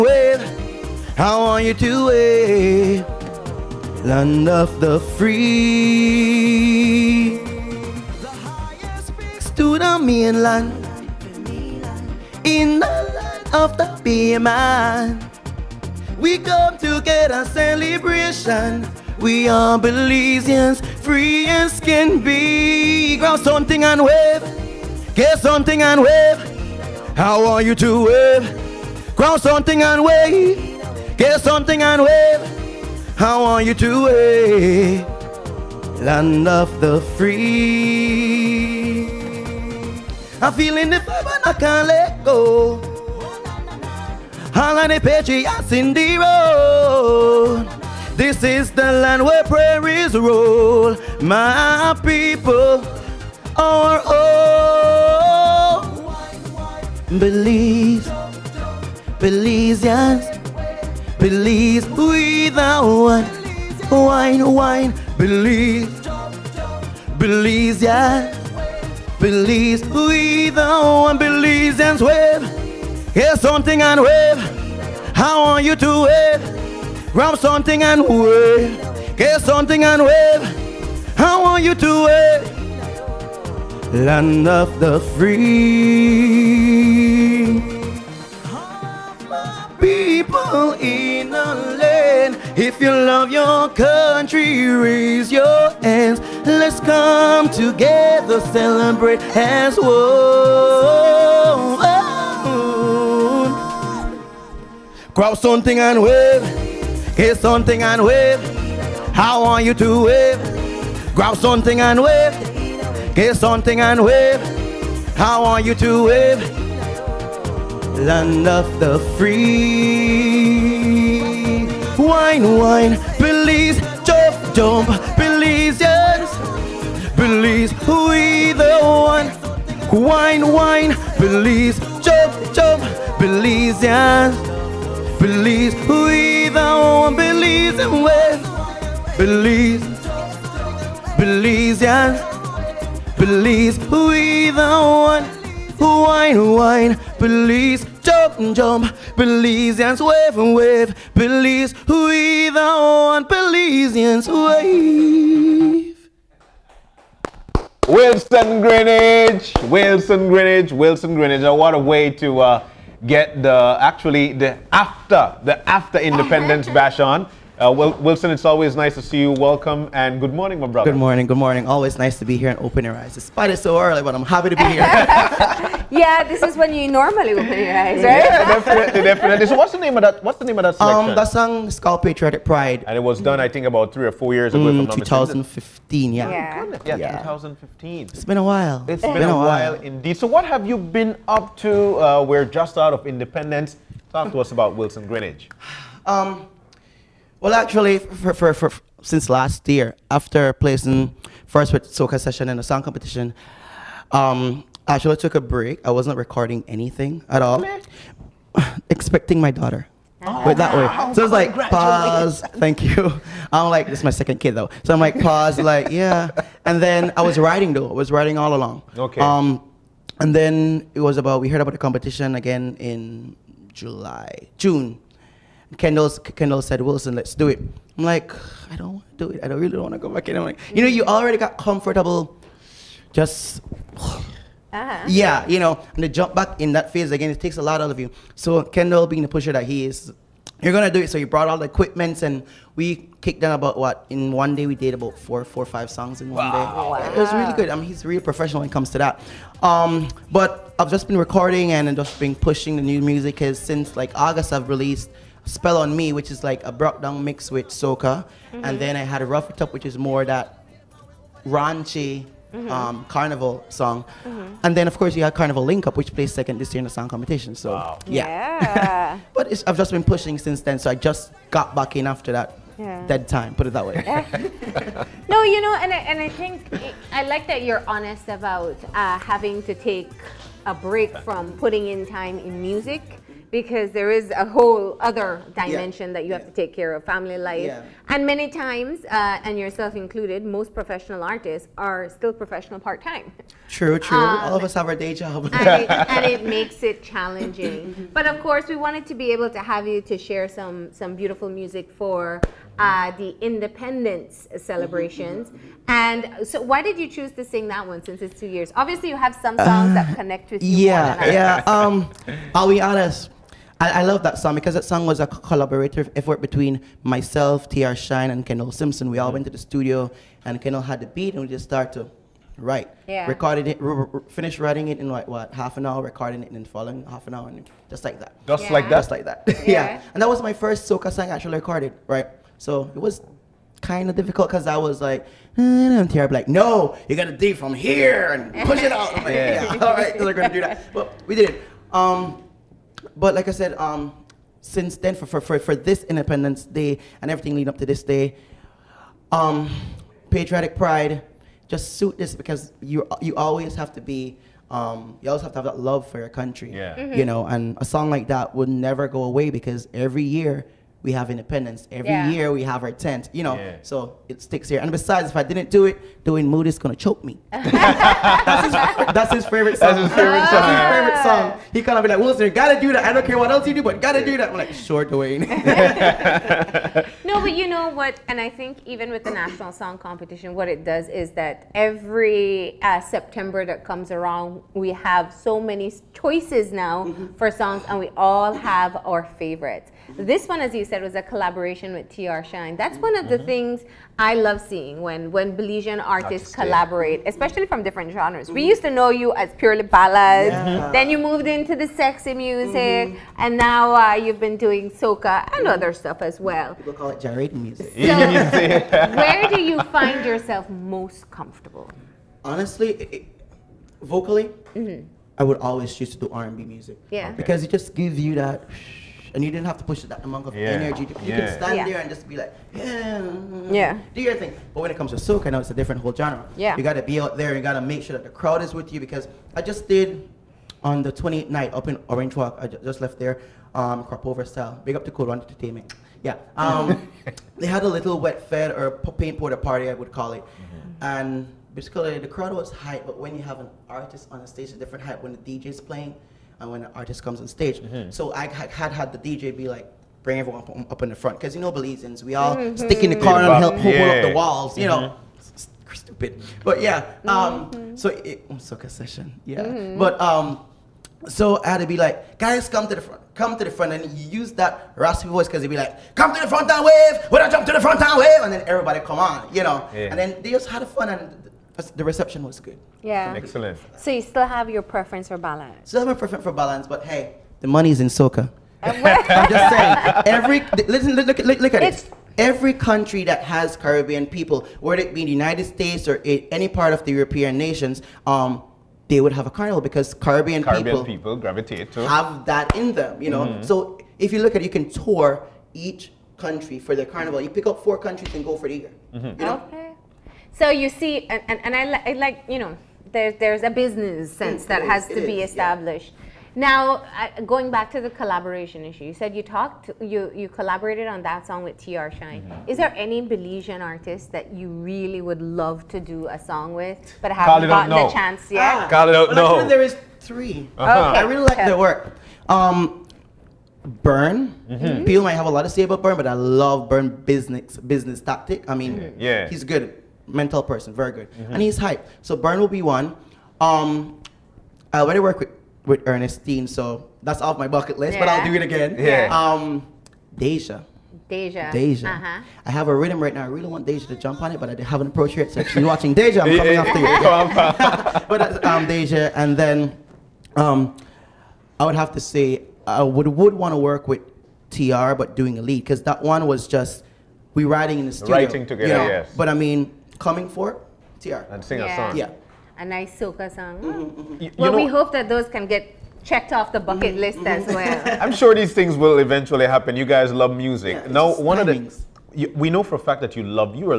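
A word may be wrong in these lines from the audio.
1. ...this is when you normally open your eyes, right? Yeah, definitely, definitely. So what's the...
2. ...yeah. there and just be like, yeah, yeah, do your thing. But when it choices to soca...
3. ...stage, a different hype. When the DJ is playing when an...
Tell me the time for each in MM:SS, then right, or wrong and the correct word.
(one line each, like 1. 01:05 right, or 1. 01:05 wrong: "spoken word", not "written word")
1. 02:56 right
2. 07:01 wrong: "comes", not "choices"
3. 07:24 right.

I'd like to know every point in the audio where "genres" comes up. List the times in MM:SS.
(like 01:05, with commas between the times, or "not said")
06:38, 07:06.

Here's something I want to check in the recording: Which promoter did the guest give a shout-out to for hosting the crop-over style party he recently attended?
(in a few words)
Cool Entertainment.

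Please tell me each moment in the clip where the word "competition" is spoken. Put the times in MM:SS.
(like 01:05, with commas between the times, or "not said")
03:22, 03:41, 04:27, 06:19.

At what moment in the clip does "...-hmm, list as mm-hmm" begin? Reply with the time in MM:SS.
09:27.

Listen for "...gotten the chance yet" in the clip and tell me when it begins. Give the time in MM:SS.
08:37.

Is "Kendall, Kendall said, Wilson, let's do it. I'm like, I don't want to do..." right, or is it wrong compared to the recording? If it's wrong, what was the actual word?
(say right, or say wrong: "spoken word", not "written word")
right.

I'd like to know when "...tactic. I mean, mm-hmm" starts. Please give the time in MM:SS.
08:48.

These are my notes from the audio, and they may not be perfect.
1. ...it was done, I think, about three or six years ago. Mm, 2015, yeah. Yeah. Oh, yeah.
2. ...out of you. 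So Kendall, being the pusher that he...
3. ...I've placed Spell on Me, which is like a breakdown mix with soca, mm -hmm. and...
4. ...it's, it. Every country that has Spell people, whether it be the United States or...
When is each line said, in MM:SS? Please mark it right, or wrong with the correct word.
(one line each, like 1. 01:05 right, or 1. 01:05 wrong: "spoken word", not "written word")
1. 03:02 wrong: "four", not "six"
2. 03:57 right
3. 04:14 wrong: "released", not "placed"
4. 08:01 wrong: "Caribbean", not "Spell".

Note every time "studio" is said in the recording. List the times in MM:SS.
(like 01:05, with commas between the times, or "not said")
05:19, 09:18.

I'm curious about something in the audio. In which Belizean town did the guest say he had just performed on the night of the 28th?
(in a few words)
Orange Walk.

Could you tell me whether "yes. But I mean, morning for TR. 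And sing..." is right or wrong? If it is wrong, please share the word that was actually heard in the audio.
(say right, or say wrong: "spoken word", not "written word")
wrong: "coming", not "morning".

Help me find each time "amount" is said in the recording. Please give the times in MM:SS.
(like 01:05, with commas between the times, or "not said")
07:00.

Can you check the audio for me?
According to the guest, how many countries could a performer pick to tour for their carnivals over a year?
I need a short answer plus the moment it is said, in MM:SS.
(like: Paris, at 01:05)
4, at 08:17.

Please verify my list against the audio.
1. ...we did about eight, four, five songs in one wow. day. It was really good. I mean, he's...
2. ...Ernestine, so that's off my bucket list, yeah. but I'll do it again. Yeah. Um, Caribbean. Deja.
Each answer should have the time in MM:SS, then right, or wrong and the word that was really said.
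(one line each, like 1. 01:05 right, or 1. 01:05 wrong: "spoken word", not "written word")
1. 04:04 wrong: "four", not "eight"
2. 08:56 wrong: "Deja", not "Caribbean".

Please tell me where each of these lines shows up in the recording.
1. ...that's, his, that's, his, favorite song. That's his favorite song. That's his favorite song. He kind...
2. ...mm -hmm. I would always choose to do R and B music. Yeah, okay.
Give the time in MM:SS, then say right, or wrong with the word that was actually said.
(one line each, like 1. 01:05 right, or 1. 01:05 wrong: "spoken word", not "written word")
1. 06:07 right
2. 06:54 right.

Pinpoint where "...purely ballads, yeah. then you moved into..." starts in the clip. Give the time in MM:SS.
06:39.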